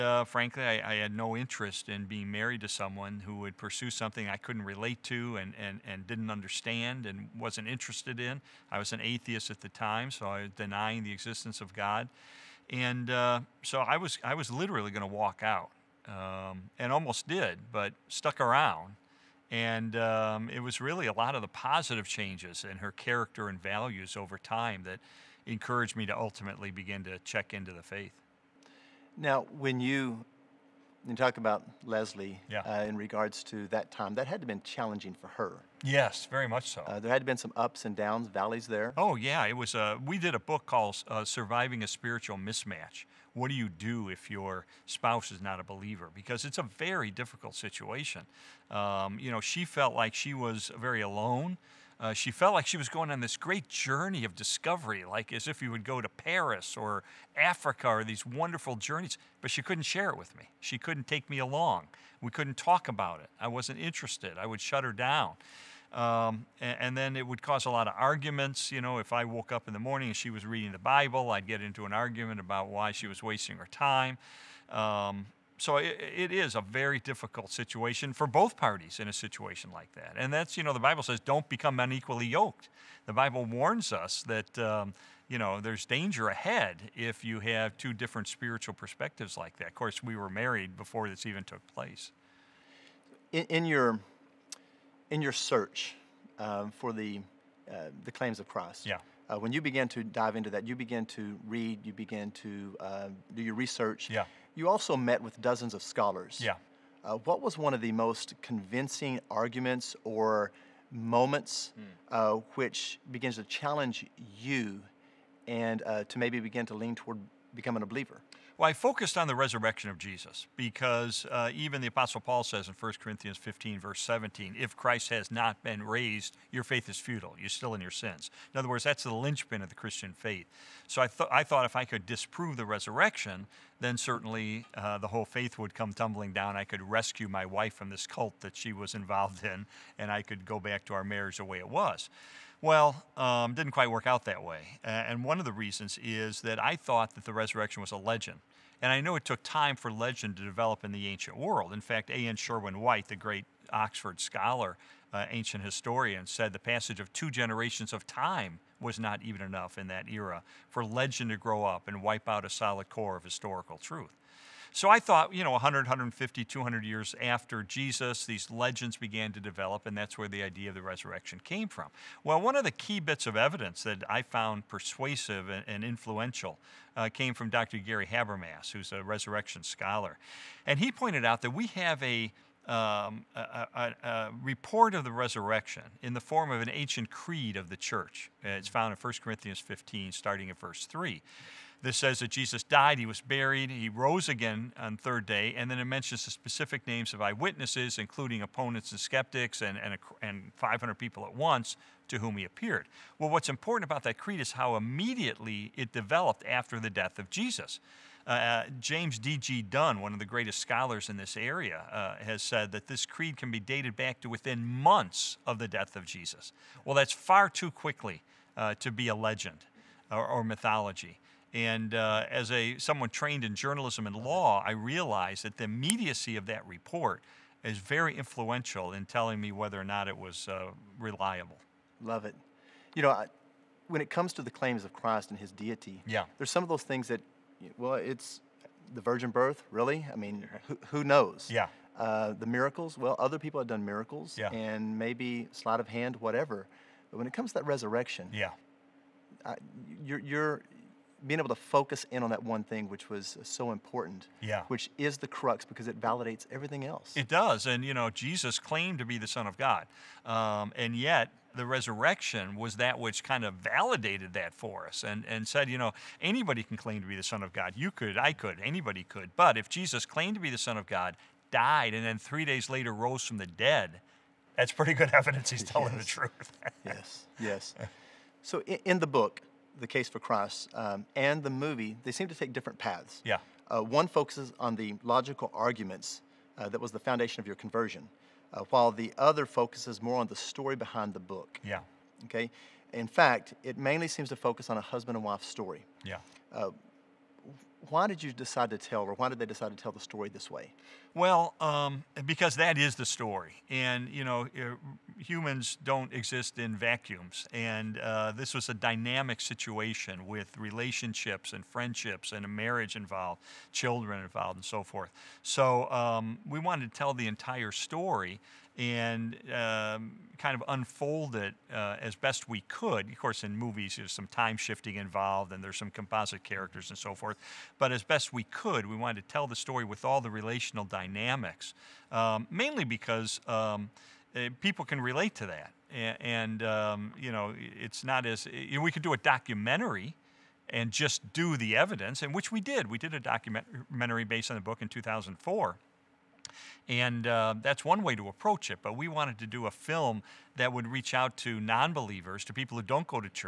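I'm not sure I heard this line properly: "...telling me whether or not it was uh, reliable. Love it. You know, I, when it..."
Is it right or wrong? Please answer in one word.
right.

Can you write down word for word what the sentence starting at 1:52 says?
uh, which begins to challenge you and uh, to maybe begin to lean toward becoming a believer?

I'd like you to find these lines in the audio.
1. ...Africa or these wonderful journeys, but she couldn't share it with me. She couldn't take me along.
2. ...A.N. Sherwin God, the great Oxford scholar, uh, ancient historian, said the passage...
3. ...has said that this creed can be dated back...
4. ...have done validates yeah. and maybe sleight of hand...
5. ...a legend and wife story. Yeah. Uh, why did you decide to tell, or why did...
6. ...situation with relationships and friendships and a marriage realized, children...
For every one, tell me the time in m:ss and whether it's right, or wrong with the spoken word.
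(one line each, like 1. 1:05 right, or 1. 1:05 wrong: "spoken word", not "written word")
1. 0:57 right
2. 2:32 wrong: "White", not "God"
3. 3:32 right
4. 4:03 wrong: "miracles", not "validates"
5. 4:54 wrong: "husband", not "legend"
6. 5:09 wrong: "involved", not "realized".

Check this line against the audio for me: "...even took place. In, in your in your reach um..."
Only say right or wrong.
wrong.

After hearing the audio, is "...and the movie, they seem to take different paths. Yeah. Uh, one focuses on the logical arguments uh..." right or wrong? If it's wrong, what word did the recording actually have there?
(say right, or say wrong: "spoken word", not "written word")
right.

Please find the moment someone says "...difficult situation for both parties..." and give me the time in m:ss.
1:16.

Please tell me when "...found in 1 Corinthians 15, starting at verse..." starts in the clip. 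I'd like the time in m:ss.
3:08.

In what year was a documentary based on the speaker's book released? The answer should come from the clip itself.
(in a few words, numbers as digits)
2004.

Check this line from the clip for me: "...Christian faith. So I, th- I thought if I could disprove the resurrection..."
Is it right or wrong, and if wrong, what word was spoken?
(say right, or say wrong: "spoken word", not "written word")
right.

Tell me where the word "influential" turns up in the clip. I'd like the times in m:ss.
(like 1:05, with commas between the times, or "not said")
2:55, 3:48.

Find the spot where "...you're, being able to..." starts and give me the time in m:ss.
4:10.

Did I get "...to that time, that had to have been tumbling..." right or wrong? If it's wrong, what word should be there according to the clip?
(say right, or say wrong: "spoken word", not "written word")
wrong: "challenging", not "tumbling".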